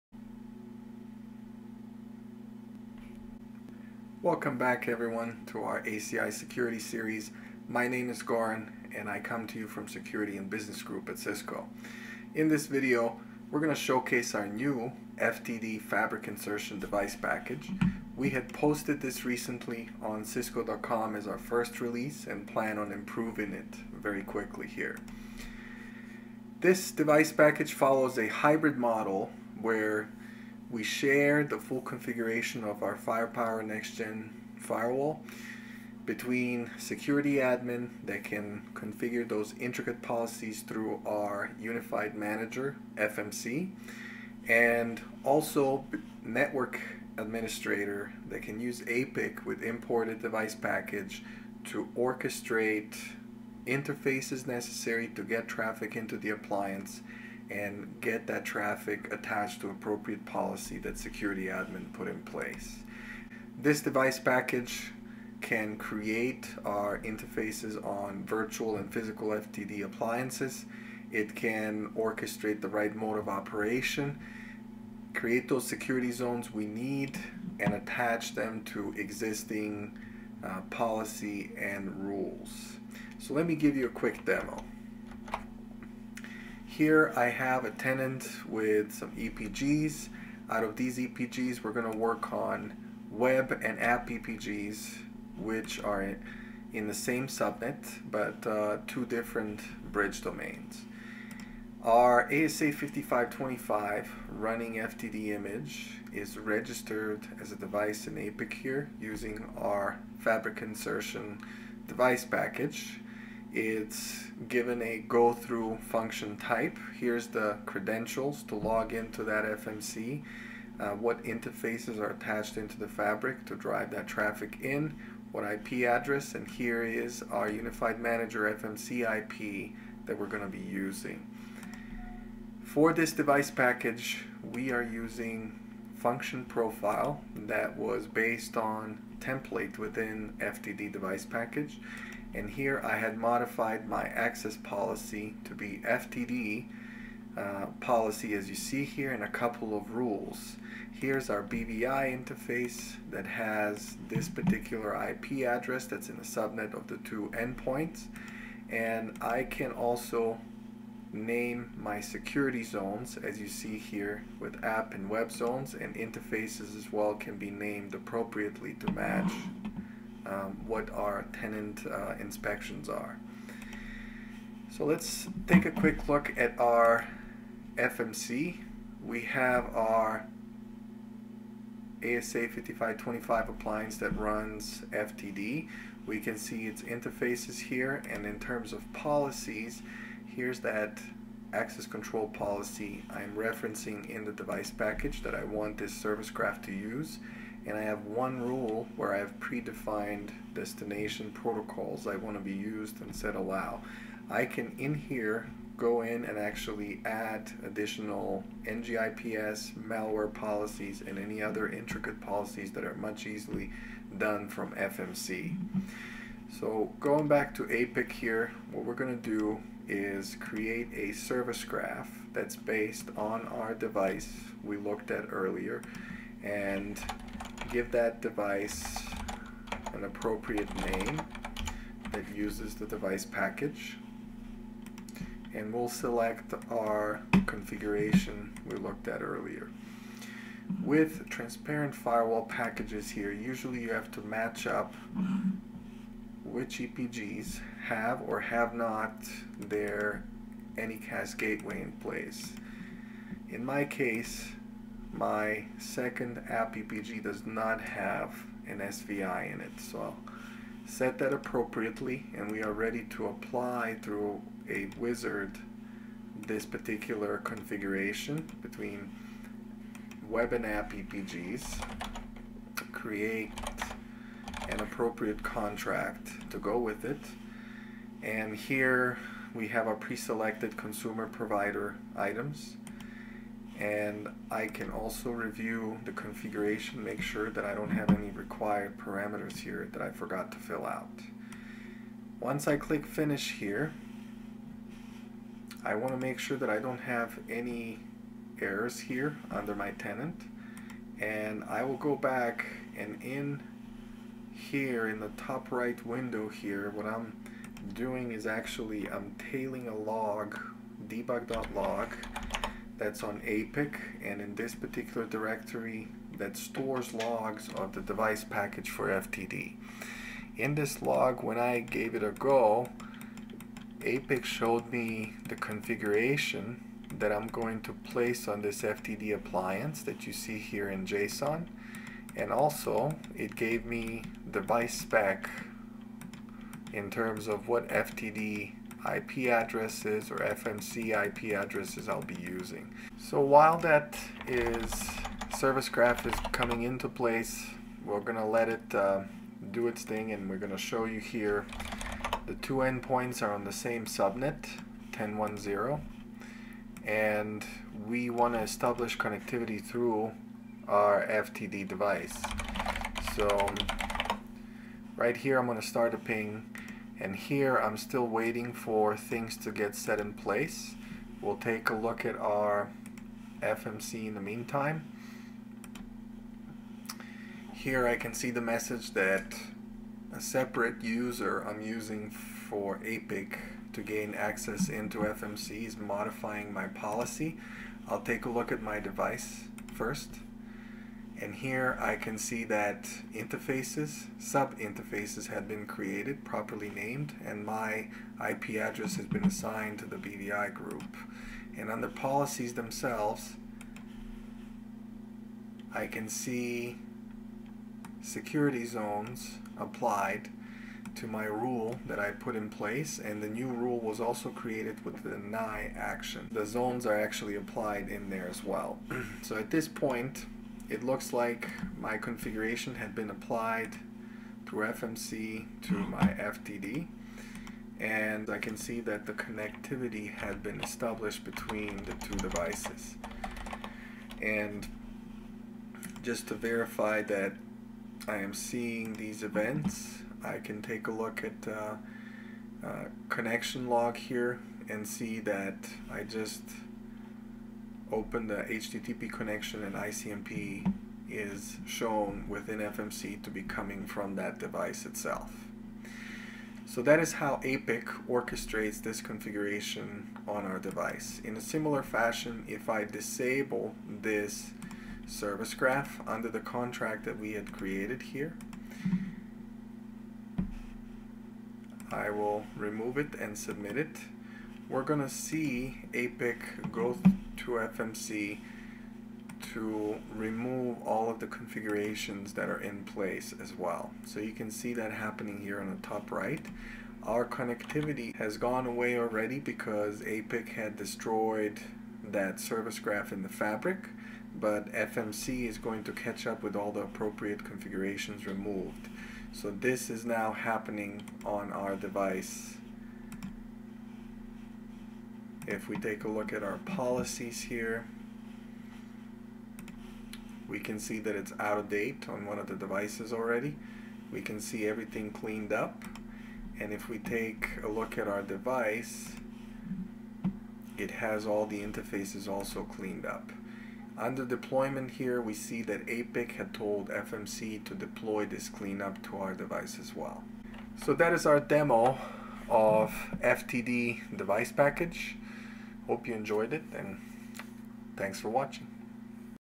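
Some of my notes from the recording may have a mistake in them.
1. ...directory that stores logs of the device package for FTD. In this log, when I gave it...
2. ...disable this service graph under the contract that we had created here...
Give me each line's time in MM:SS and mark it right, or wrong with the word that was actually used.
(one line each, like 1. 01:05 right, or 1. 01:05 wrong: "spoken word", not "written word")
1. 05:15 right
2. 07:43 right.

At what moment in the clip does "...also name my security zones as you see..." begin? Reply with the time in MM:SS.
02:39.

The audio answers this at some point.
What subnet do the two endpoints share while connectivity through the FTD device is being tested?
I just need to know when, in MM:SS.
05:55.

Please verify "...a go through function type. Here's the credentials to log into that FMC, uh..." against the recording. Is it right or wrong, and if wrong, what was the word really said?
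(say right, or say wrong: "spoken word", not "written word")
right.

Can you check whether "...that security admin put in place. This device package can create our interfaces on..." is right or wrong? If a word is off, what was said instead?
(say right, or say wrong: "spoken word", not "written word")
right.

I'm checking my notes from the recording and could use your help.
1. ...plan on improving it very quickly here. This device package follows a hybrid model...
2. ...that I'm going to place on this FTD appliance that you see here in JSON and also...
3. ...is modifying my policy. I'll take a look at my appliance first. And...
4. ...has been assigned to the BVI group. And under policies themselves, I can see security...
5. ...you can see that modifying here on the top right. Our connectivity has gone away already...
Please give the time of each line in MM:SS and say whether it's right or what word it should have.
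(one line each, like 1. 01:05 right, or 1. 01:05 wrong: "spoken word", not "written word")
1. 00:22 right
2. 05:27 right
3. 06:25 wrong: "device", not "appliance"
4. 06:39 right
5. 08:04 wrong: "happening", not "modifying".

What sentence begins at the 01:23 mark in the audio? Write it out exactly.
So let me give you a quick demo.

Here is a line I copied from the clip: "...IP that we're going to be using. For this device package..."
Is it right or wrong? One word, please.
right.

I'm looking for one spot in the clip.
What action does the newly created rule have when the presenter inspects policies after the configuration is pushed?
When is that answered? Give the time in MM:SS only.
06:55.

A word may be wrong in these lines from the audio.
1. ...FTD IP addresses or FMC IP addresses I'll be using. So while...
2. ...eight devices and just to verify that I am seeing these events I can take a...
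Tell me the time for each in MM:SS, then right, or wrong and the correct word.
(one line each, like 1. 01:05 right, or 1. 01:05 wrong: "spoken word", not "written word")
1. 05:37 right
2. 07:12 wrong: "two", not "eight".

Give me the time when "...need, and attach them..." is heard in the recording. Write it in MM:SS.
01:16.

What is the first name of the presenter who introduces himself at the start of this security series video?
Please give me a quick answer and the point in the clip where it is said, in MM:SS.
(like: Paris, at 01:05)
Goran, at 00:08.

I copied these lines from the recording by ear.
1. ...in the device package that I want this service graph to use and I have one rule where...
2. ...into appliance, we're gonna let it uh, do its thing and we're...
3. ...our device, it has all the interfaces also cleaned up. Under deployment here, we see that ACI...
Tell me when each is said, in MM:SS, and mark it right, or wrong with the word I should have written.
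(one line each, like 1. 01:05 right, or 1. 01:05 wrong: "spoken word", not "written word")
1. 03:14 right
2. 05:46 wrong: "place", not "appliance"
3. 08:38 wrong: "APIC", not "ACI".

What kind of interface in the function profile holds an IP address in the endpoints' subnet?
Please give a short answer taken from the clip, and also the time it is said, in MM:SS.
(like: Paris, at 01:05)
BVI interface, at 02:31.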